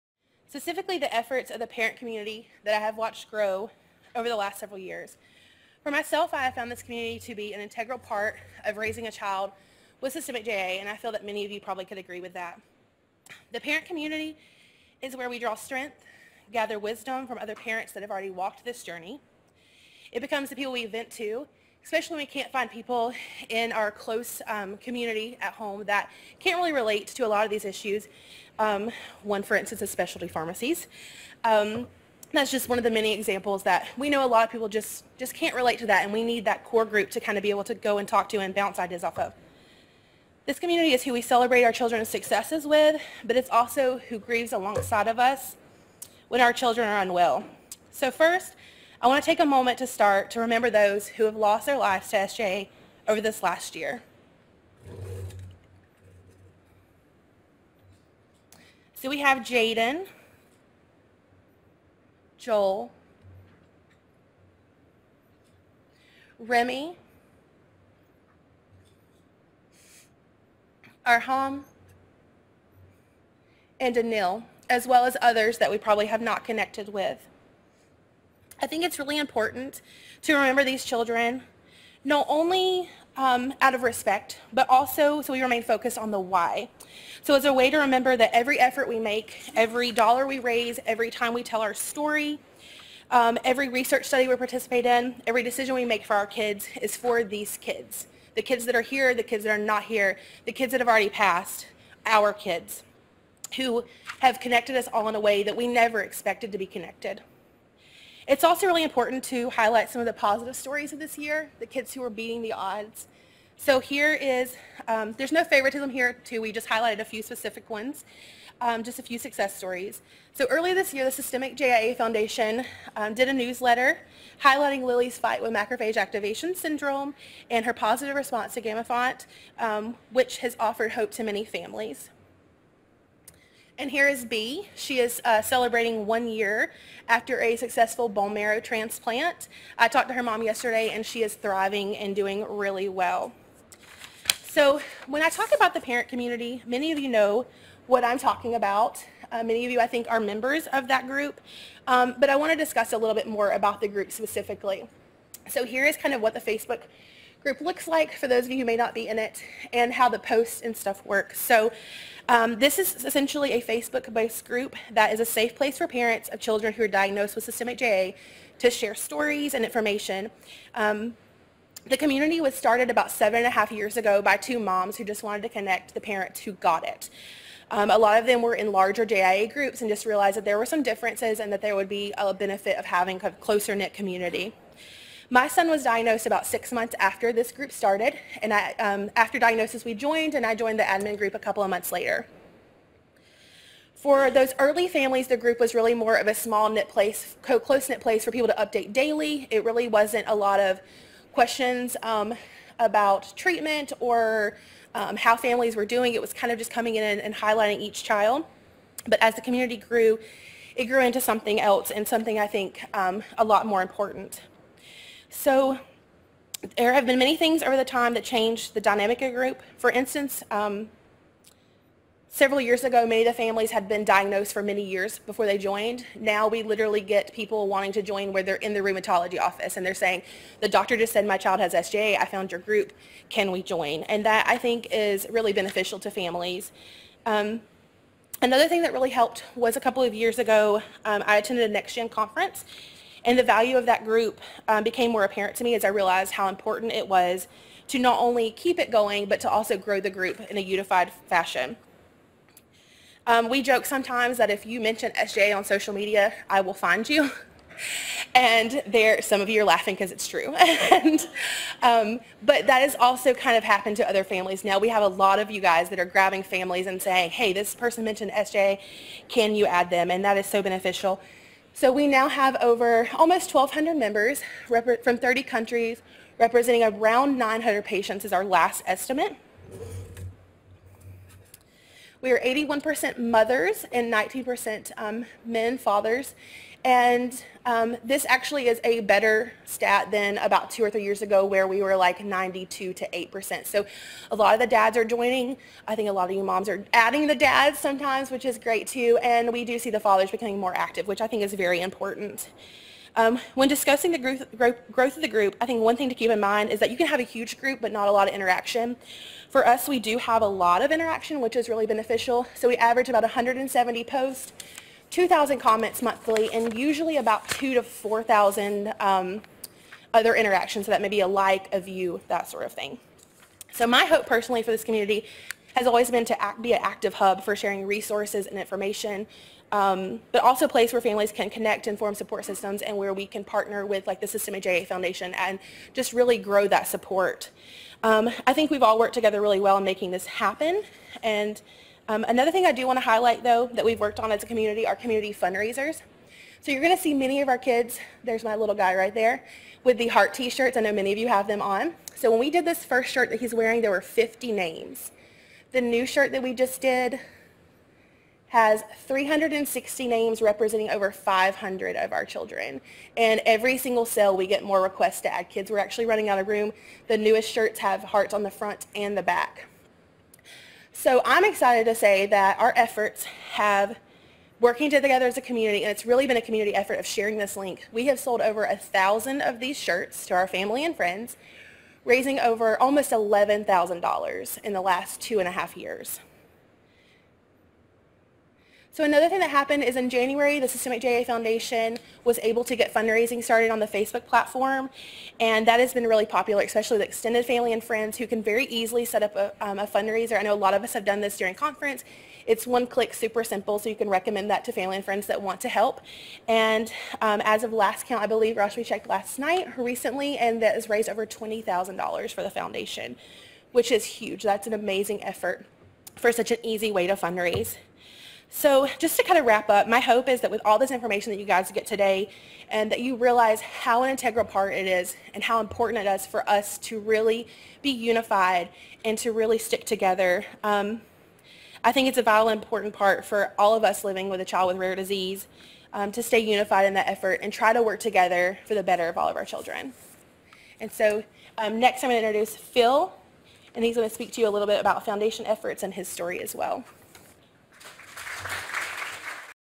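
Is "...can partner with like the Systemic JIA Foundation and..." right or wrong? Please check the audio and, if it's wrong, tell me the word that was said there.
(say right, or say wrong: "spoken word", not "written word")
right.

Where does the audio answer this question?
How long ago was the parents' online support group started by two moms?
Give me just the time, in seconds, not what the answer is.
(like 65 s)
173 s.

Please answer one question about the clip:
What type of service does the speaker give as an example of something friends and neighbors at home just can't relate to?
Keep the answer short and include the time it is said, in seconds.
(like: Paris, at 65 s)
specialty pharmacies, at 29 s.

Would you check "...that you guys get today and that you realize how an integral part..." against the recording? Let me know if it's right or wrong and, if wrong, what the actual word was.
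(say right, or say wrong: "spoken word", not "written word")
right.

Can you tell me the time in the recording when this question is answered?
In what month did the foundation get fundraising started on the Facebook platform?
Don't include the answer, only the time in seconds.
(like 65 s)
390 s.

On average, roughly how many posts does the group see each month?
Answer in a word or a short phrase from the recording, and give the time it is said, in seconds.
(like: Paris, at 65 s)
170, at 313 s.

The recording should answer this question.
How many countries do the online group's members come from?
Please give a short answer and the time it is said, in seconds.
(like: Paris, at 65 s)
30, at 275 s.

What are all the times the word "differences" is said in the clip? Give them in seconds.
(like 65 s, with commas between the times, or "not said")
180 s.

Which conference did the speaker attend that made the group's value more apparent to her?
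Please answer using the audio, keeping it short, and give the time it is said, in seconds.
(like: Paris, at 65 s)
NextGen, at 241 s.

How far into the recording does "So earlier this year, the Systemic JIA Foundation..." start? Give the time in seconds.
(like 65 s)
120 s.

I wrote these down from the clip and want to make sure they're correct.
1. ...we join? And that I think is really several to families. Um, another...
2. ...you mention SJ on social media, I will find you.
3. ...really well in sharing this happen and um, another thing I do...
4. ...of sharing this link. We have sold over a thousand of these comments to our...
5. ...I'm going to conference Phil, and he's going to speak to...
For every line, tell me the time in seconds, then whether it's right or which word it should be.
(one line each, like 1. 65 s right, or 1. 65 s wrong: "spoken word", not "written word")
1. 233 s wrong: "beneficial", not "several"
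2. 254 s right
3. 339 s wrong: "making", not "sharing"
4. 376 s wrong: "shirts", not "comments"
5. 442 s wrong: "introduce", not "conference".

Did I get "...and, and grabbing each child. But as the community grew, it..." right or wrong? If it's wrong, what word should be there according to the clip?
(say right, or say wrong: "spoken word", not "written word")
wrong: "highlighting", not "grabbing".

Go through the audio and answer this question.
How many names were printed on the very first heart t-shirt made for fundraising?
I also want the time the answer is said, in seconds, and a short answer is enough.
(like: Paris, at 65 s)
50, at 354 s.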